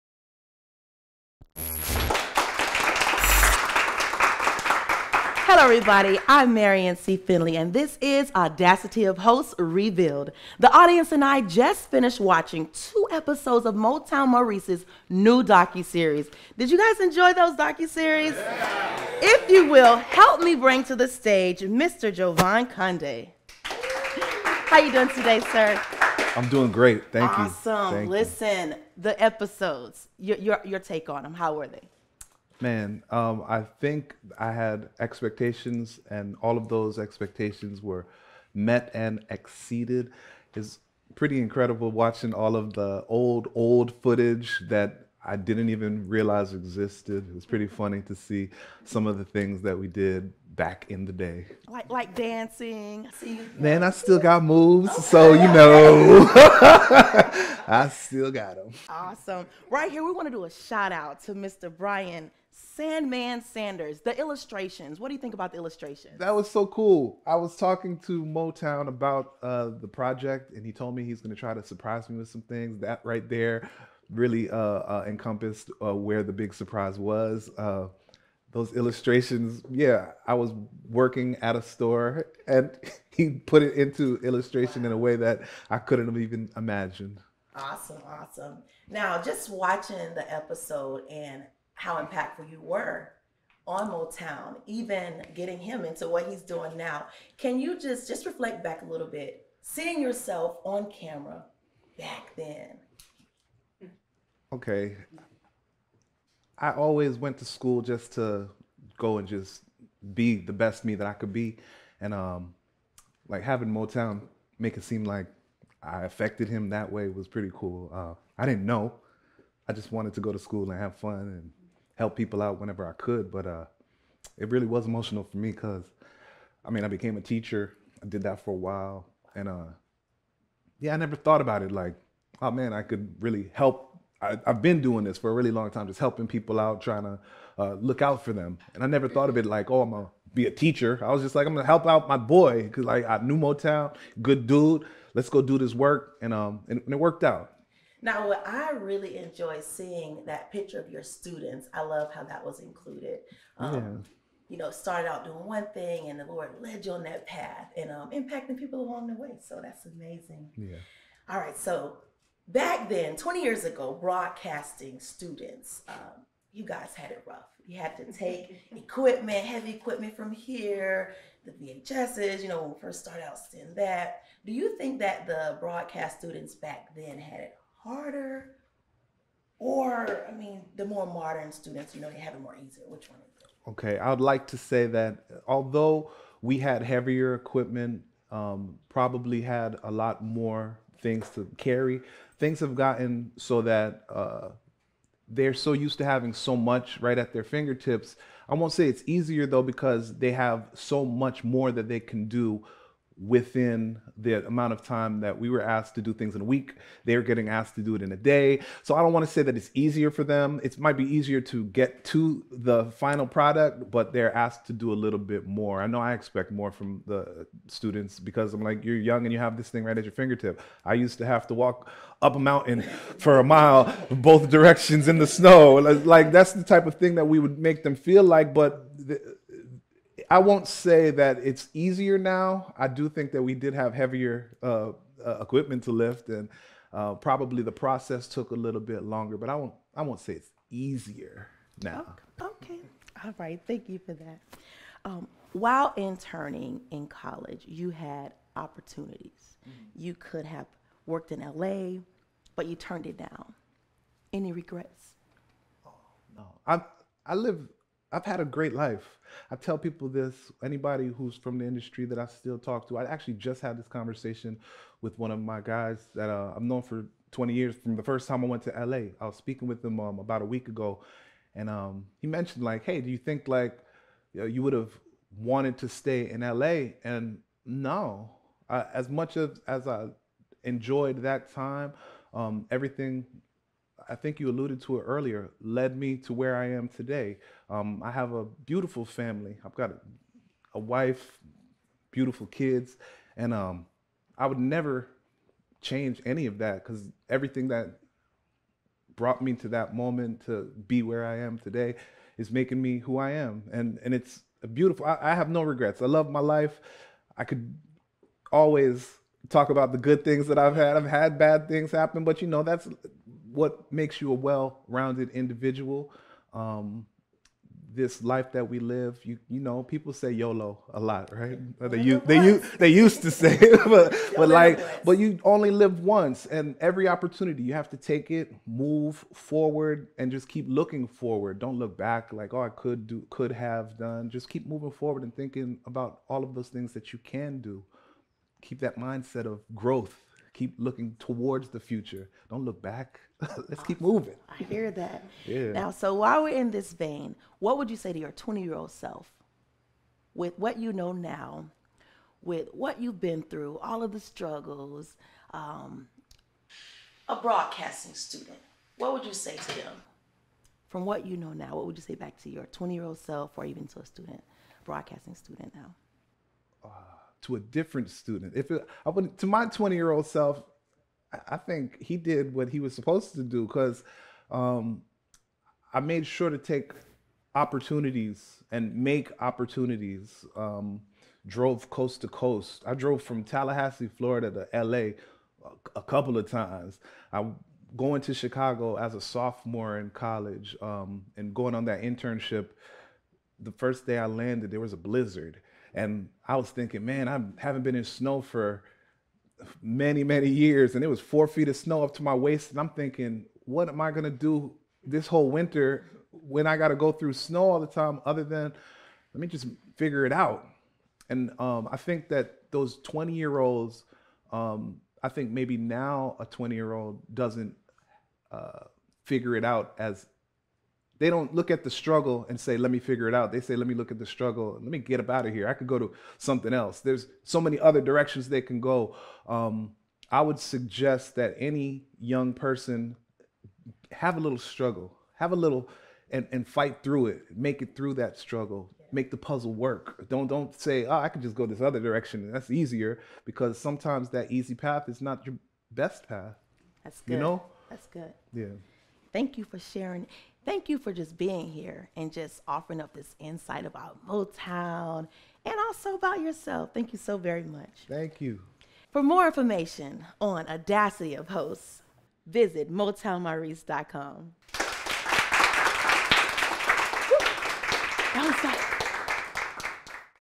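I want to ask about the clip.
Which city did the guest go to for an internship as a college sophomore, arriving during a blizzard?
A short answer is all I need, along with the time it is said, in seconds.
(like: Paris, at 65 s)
Chicago, at 388 s.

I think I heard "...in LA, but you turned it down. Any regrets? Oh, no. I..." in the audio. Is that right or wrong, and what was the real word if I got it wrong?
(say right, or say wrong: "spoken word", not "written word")
right.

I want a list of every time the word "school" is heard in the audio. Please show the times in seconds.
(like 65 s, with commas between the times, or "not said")
107 s, 120 s.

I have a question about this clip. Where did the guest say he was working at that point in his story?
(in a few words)
A store.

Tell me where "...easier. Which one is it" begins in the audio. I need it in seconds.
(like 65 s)
182 s.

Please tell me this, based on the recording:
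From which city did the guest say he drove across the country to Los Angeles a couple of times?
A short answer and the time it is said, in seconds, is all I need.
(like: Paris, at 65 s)
Tallahassee, Florida, at 383 s.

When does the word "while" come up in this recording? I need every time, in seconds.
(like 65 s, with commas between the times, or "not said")
128 s, 245 s, 346 s.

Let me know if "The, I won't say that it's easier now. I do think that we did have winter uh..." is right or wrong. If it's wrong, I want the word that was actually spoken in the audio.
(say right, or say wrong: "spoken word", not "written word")
wrong: "heavier", not "winter".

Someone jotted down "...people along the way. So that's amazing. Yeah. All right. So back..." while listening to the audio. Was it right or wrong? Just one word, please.
right.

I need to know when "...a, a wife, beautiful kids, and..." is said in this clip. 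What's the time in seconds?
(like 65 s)
289 s.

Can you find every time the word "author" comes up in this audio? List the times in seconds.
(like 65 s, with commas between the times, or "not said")
not said.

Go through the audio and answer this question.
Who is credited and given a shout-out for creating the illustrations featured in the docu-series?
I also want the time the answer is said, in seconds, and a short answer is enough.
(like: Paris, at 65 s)
Brian Sandman Sanders, at 61 s.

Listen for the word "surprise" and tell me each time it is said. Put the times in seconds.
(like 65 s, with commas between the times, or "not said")
71 s, 76 s.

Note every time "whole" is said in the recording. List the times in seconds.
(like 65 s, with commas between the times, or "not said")
405 s.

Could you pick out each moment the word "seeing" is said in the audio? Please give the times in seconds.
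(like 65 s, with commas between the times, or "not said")
99 s, 149 s.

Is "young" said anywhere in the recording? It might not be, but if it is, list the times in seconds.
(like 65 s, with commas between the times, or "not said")
218 s, 432 s.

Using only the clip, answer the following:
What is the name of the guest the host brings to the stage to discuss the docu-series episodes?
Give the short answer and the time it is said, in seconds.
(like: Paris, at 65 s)
Jovan Condé, at 22 s.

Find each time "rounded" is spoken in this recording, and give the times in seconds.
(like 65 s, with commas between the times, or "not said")
314 s.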